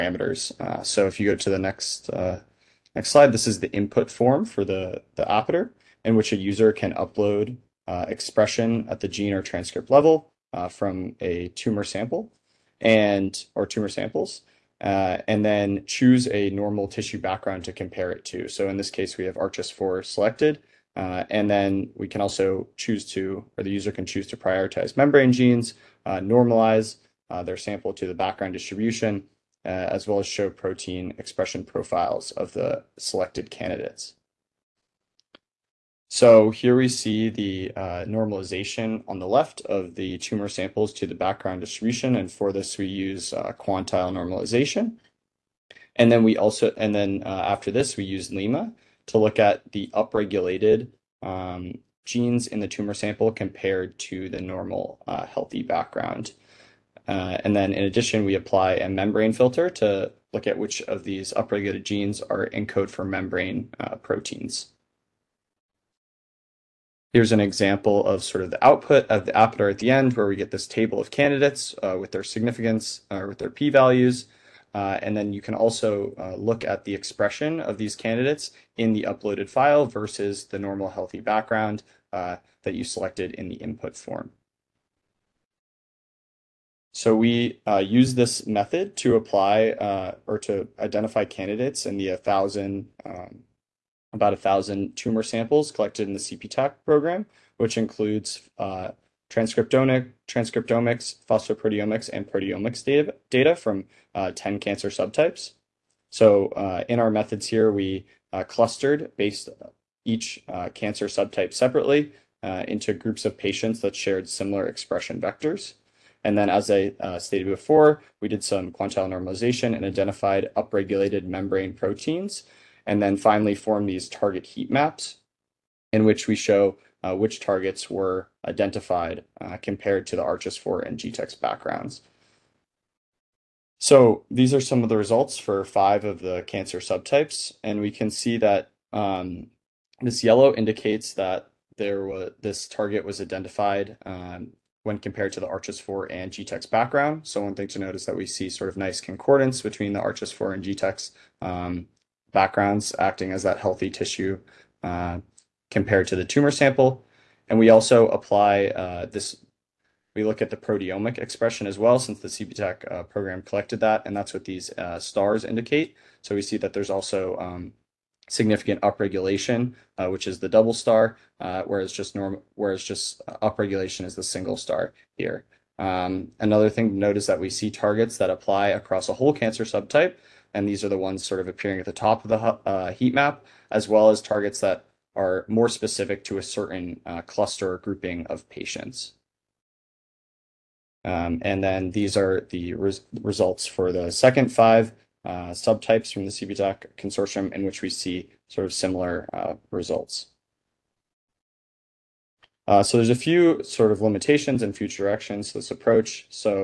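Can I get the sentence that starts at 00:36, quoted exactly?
So here we see the uh, normalization on the left of the tumor samples to the background distribution.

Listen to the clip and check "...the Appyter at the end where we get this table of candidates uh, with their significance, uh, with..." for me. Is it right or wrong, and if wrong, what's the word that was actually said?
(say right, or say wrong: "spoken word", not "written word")
right.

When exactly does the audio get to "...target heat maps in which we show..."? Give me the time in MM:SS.
02:04.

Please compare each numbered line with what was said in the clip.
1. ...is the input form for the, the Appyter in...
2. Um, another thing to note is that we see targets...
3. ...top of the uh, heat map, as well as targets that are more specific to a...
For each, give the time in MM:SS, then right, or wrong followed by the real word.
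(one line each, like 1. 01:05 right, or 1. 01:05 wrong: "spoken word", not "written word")
1. 00:03 right
2. 02:55 right
3. 03:01 right.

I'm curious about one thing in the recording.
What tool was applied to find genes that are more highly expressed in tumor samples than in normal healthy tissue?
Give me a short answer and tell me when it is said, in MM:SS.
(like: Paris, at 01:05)
limma, at 00:48.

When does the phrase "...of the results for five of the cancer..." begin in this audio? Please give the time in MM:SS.
02:14.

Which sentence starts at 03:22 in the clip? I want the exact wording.
Uh, so there's a few sort of limitations and future directions to this approach.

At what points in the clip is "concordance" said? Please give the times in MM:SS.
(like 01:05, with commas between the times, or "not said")
02:29.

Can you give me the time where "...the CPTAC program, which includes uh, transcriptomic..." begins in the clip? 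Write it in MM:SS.
01:36.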